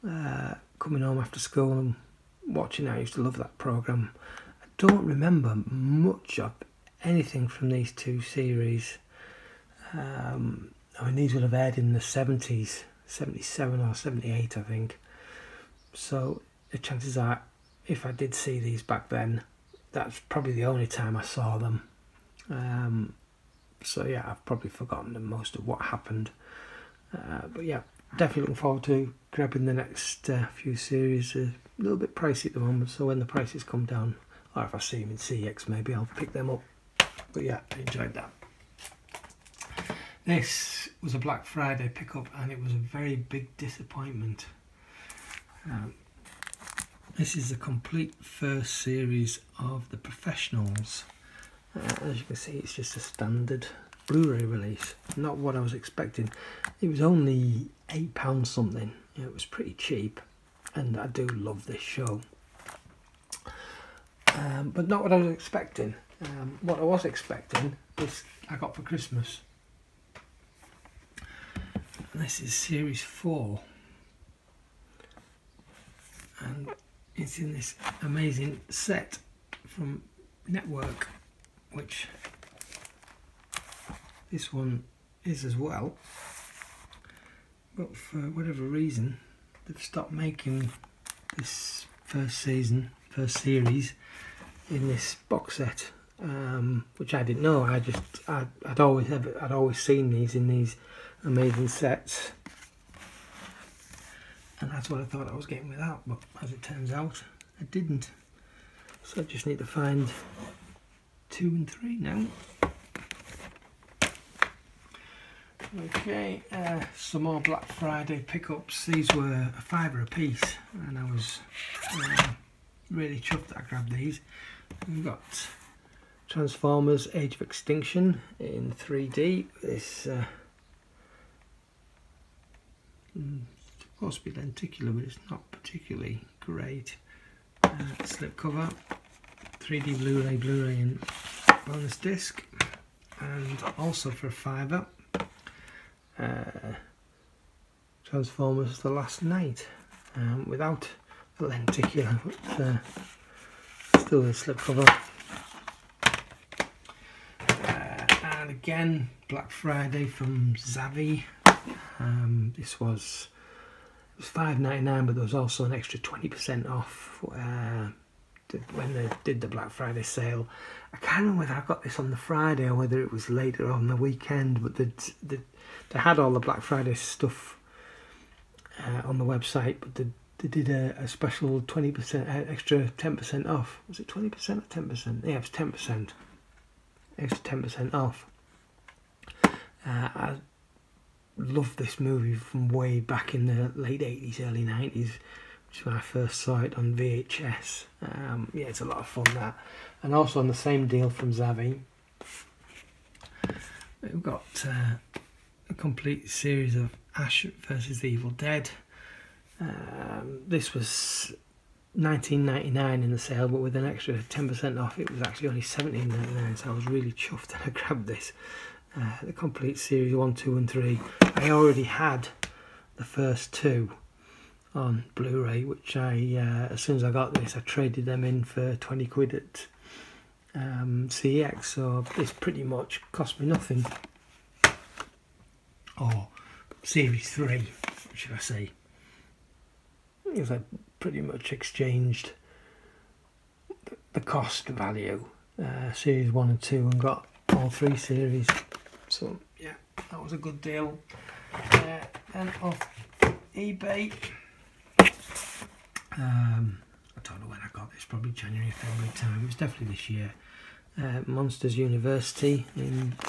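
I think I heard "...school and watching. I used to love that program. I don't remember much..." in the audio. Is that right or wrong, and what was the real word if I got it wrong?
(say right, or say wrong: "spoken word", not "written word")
right.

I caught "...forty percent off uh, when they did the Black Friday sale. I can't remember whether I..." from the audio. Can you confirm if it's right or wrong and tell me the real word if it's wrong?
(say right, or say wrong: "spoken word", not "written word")
wrong: "twenty", not "forty".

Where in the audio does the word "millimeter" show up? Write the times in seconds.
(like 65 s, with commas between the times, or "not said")
not said.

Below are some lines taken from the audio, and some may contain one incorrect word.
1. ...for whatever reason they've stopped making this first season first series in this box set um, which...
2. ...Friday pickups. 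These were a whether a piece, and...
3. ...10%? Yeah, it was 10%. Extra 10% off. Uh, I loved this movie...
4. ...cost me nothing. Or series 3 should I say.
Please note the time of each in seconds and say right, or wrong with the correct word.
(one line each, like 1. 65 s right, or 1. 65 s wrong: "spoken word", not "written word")
1. 87 s right
2. 117 s wrong: "fiver", not "whether"
3. 184 s right
4. 233 s right.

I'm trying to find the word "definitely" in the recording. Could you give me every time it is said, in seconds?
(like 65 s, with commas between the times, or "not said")
28 s, 259 s.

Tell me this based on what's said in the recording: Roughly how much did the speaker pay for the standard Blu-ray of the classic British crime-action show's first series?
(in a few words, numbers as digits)
£8.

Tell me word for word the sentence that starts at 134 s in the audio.
to be lenticular, but it's not particularly great.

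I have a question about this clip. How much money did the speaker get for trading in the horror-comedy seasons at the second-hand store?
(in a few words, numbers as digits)
£20.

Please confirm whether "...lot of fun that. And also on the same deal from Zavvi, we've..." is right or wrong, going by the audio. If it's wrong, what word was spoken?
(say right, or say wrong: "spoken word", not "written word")
right.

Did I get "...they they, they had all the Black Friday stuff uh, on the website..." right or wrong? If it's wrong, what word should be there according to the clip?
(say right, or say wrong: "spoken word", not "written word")
right.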